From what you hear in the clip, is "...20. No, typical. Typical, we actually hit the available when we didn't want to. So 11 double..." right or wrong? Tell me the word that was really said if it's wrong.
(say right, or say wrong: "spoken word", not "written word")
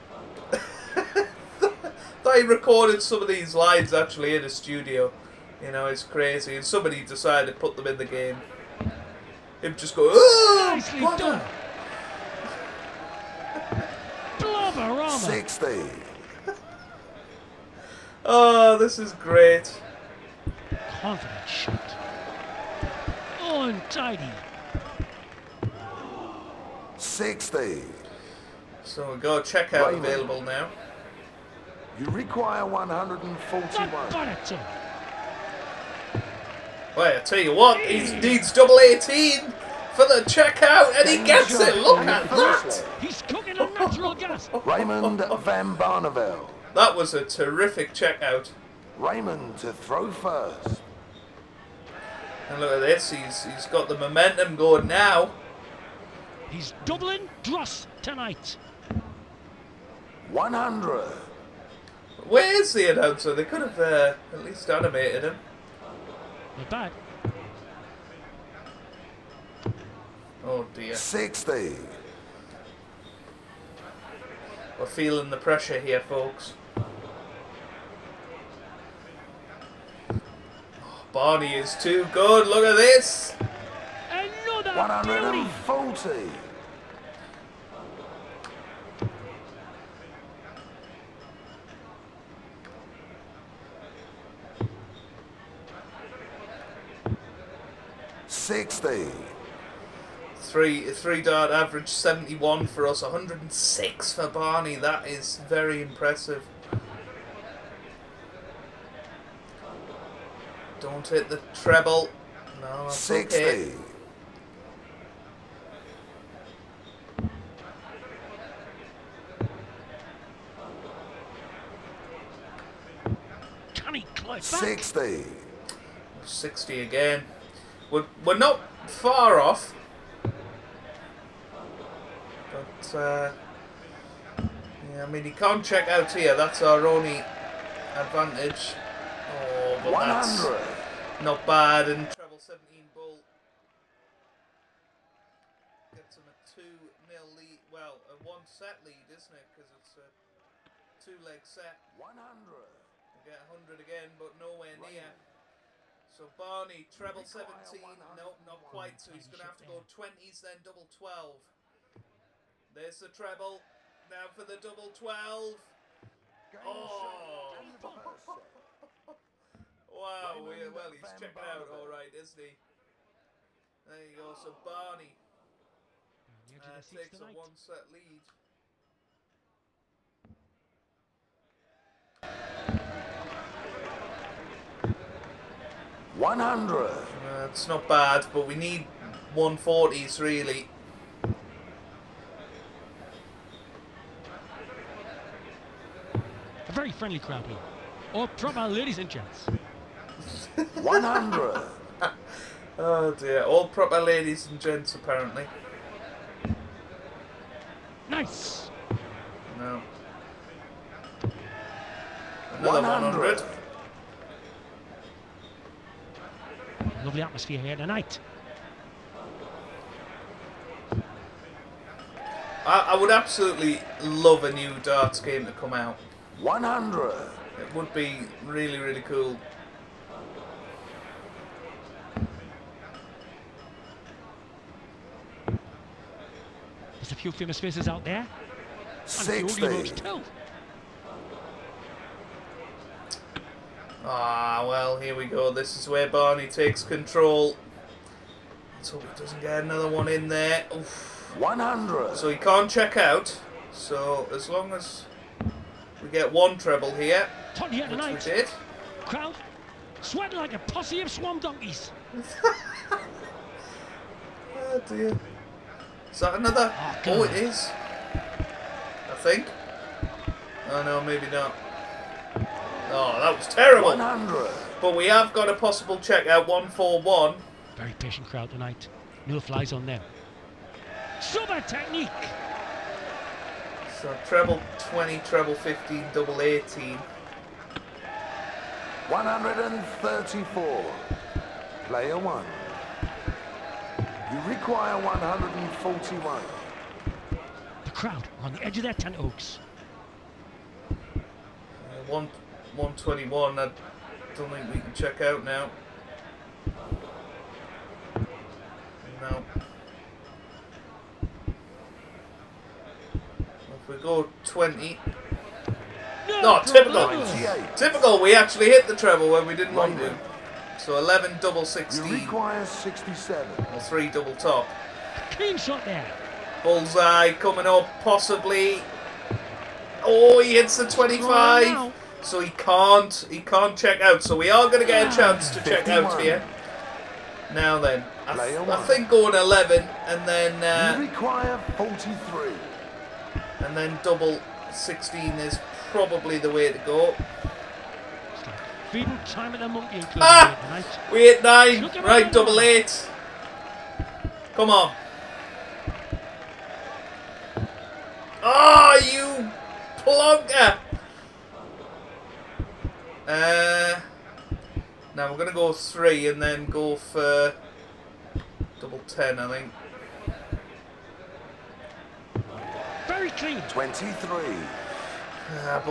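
wrong: "treble", not "available".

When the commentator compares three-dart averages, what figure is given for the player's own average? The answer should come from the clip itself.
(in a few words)
71.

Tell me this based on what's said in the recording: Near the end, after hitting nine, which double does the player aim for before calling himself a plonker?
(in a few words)
double eight.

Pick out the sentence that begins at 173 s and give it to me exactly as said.
There you go, so Barney uh, takes a one-set lead.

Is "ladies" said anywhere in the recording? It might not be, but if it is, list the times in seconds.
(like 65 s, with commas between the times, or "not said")
198 s, 204 s.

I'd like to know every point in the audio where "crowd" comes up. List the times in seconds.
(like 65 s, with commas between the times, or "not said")
197 s, 259 s, 278 s, 297 s.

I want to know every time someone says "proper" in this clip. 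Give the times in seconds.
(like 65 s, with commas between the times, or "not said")
198 s, 203 s.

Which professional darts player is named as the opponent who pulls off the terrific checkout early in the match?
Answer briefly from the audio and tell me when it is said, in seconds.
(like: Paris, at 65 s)
Raymond Van Barneveld, at 44 s.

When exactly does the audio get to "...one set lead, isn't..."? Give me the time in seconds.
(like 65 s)
148 s.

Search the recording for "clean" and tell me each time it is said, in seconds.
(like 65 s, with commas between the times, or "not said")
325 s, 373 s.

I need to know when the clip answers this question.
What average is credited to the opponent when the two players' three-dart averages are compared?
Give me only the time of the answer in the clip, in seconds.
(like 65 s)
103 s.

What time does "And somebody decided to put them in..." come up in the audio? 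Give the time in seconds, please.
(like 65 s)
6 s.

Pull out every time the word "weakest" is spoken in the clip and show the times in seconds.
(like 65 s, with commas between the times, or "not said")
not said.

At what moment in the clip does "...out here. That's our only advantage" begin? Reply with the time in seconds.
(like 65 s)
135 s.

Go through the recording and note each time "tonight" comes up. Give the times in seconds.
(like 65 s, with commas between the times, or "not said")
58 s, 217 s, 278 s.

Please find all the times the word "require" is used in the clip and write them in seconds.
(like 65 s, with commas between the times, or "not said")
32 s, 294 s, 322 s, 341 s.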